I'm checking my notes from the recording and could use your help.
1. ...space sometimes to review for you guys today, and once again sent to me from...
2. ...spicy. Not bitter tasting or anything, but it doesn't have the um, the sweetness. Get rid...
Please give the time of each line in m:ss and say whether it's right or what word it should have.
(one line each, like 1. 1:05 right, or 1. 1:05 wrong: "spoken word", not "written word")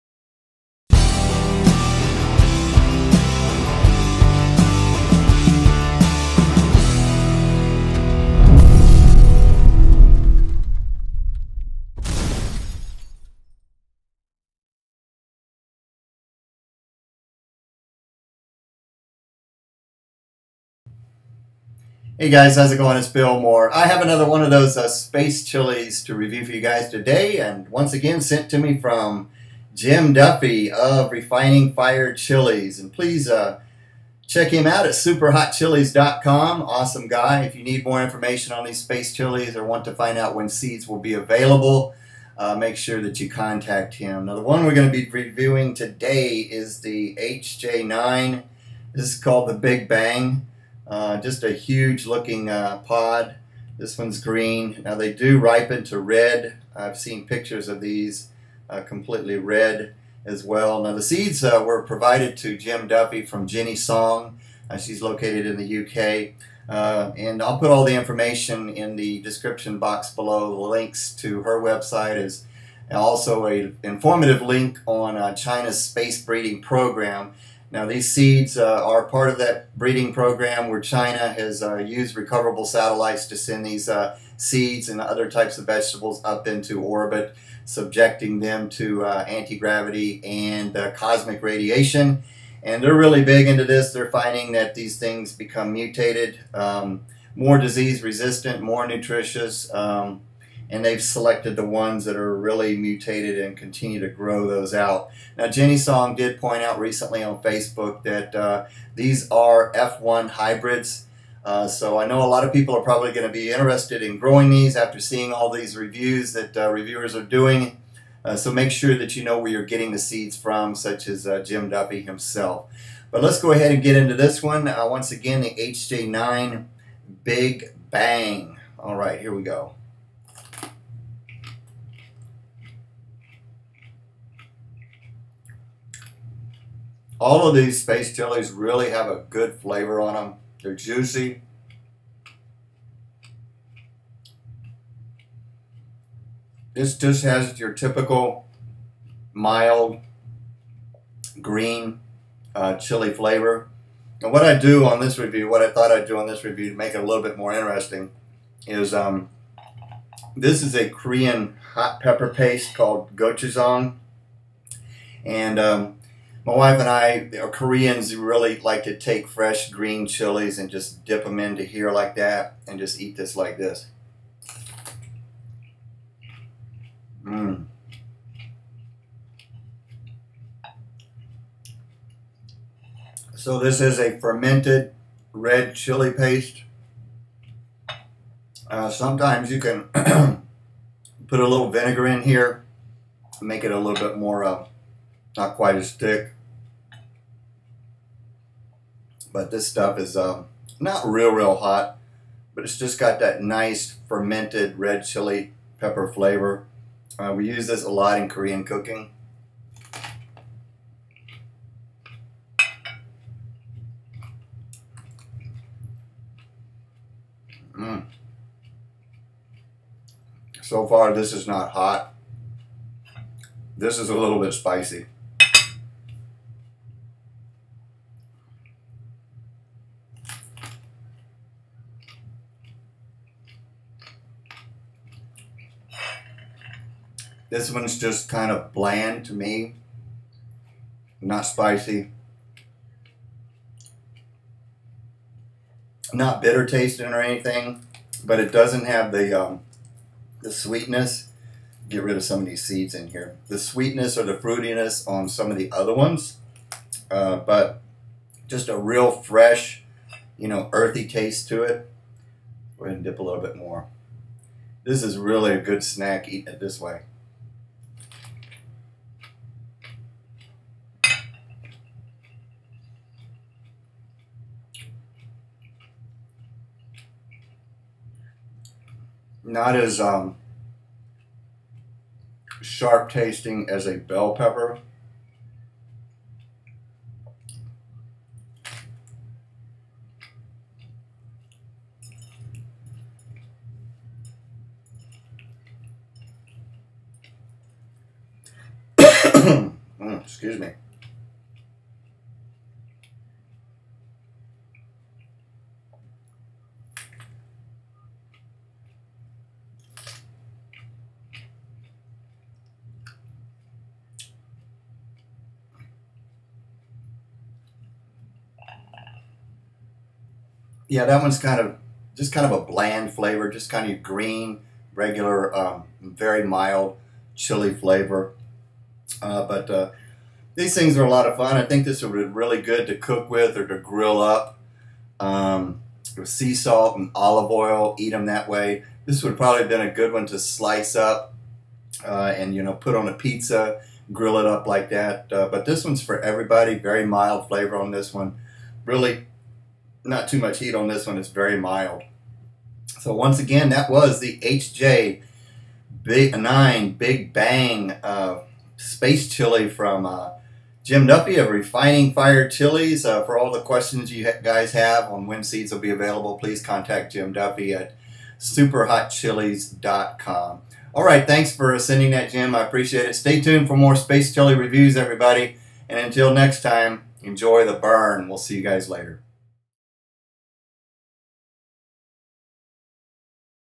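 1. 0:24 wrong: "chilies", not "sometimes"
2. 4:01 right.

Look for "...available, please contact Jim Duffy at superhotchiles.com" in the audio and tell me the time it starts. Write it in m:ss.
6:05.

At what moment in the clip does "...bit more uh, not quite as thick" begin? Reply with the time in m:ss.
3:14.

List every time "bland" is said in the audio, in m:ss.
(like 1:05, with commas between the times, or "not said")
3:58, 5:22.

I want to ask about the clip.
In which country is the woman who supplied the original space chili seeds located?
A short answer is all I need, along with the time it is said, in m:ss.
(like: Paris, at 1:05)
UK, at 1:05.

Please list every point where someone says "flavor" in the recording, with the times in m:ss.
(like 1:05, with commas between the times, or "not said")
2:19, 2:33, 3:26, 5:23, 5:27, 5:47.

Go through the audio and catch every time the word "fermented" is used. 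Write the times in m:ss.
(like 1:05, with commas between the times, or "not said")
3:04, 3:24.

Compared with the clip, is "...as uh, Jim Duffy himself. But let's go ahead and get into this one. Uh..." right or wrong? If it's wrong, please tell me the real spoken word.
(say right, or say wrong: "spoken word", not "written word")
right.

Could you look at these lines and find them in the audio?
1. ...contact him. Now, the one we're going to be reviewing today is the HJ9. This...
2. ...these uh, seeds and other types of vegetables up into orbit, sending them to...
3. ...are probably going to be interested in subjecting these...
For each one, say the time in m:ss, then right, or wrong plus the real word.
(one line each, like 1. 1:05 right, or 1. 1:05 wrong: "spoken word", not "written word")
1. 0:43 right
2. 1:23 wrong: "subjecting", not "sending"
3. 1:52 wrong: "growing", not "subjecting".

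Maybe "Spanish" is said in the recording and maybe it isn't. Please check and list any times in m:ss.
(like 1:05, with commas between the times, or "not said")
not said.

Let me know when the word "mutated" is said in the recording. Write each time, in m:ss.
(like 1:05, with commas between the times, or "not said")
1:35, 1:42.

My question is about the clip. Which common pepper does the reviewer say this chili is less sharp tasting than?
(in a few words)
bell pepper.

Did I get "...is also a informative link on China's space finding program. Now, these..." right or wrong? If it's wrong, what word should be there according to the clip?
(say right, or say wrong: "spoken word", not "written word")
wrong: "breeding", not "finding".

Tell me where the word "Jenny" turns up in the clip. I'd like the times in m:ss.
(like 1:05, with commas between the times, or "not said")
1:03, 1:45.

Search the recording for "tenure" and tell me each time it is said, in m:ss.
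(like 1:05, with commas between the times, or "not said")
not said.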